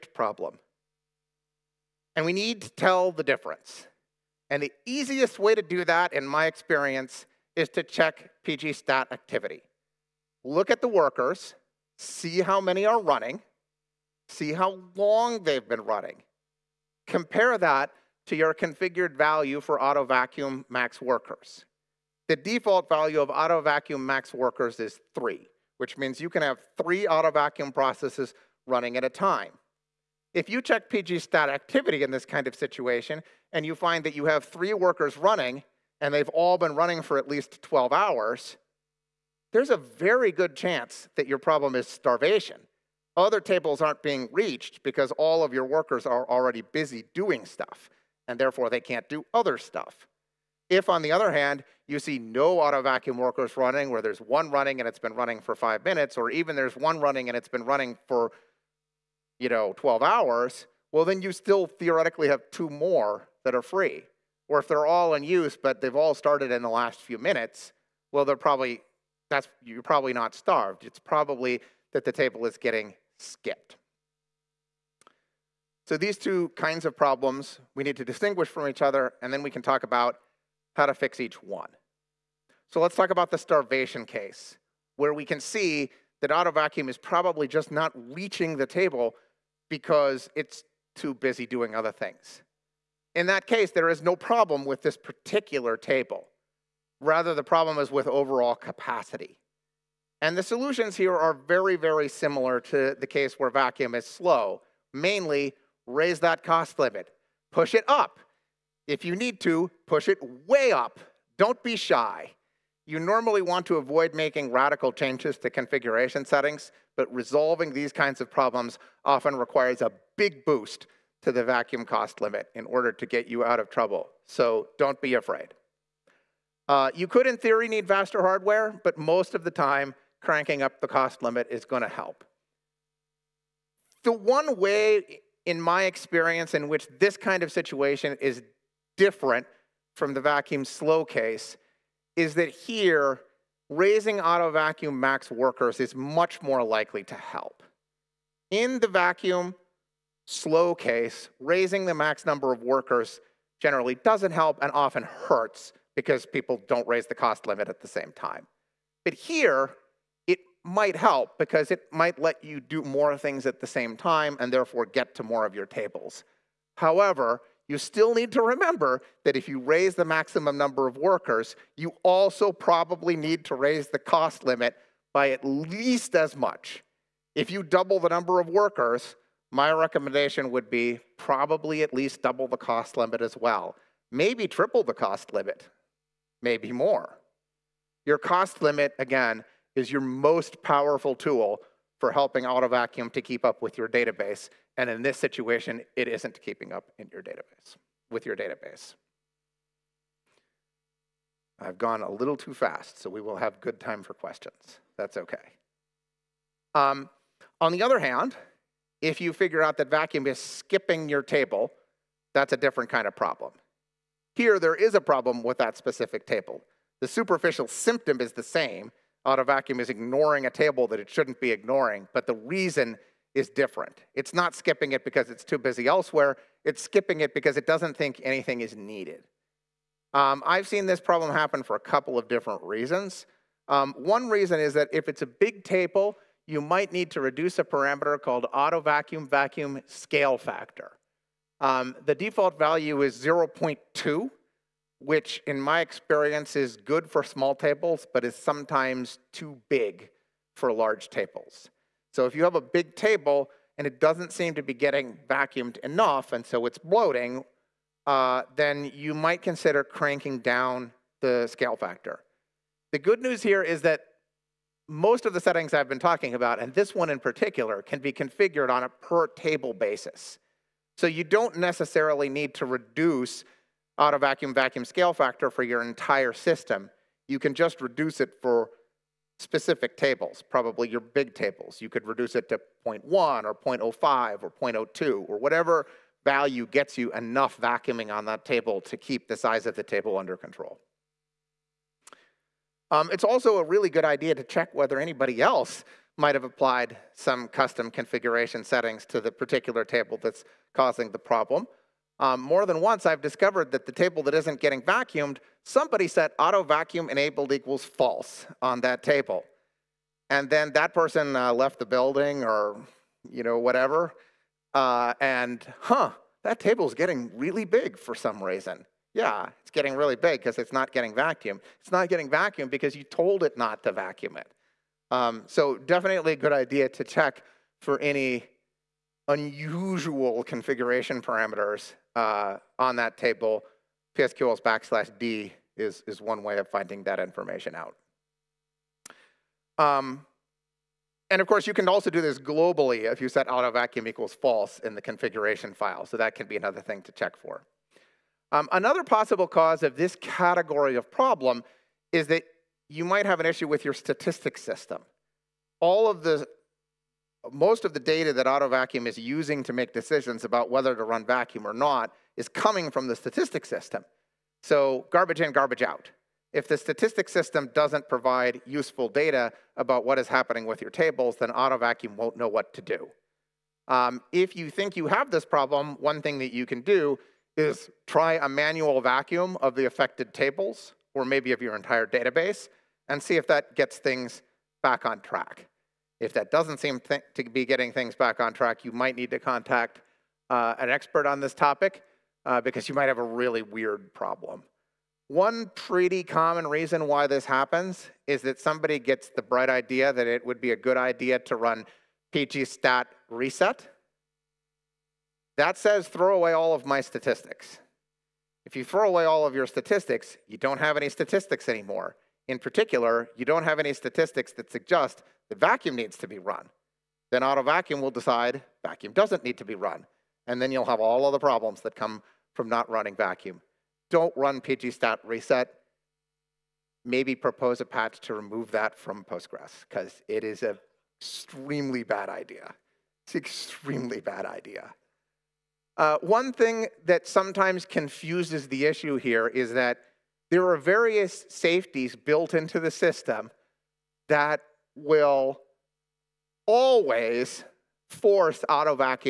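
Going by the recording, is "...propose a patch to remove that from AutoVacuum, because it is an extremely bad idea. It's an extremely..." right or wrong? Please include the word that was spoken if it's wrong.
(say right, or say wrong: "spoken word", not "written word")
wrong: "Postgres", not "AutoVacuum".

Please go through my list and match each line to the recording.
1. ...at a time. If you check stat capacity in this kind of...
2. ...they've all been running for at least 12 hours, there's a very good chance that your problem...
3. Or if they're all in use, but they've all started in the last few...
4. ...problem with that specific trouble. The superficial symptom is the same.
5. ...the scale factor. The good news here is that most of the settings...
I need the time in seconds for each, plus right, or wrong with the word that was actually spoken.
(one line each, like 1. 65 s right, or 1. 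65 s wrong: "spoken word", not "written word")
1. 28 s wrong: "activity", not "capacity"
2. 36 s right
3. 64 s right
4. 214 s wrong: "table", not "trouble"
5. 261 s right.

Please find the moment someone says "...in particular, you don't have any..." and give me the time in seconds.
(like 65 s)
412 s.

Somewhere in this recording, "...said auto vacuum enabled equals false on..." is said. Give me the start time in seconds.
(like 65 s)
306 s.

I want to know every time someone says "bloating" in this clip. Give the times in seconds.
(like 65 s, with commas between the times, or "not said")
256 s.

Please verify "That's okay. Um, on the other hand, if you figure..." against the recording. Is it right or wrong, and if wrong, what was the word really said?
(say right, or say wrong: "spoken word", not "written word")
right.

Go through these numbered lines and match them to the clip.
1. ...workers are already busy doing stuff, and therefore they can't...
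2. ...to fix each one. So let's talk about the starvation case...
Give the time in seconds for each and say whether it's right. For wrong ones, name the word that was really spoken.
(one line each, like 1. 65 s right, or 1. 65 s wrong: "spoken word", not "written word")
1. 45 s right
2. 80 s right.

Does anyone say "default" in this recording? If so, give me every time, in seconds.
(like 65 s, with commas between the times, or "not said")
22 s, 242 s.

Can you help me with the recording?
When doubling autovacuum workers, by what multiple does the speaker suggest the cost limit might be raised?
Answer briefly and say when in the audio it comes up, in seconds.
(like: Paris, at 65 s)
triple, at 184 s.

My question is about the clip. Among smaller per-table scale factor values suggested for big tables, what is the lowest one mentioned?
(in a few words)
0.02.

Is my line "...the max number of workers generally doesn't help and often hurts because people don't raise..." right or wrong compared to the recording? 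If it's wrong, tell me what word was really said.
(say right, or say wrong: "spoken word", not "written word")
right.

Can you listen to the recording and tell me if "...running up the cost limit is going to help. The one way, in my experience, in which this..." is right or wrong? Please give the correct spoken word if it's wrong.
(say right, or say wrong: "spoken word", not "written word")
wrong: "cranking", not "running".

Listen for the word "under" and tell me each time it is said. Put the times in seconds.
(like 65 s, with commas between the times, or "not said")
290 s.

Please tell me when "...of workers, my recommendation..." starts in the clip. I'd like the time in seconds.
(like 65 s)
178 s.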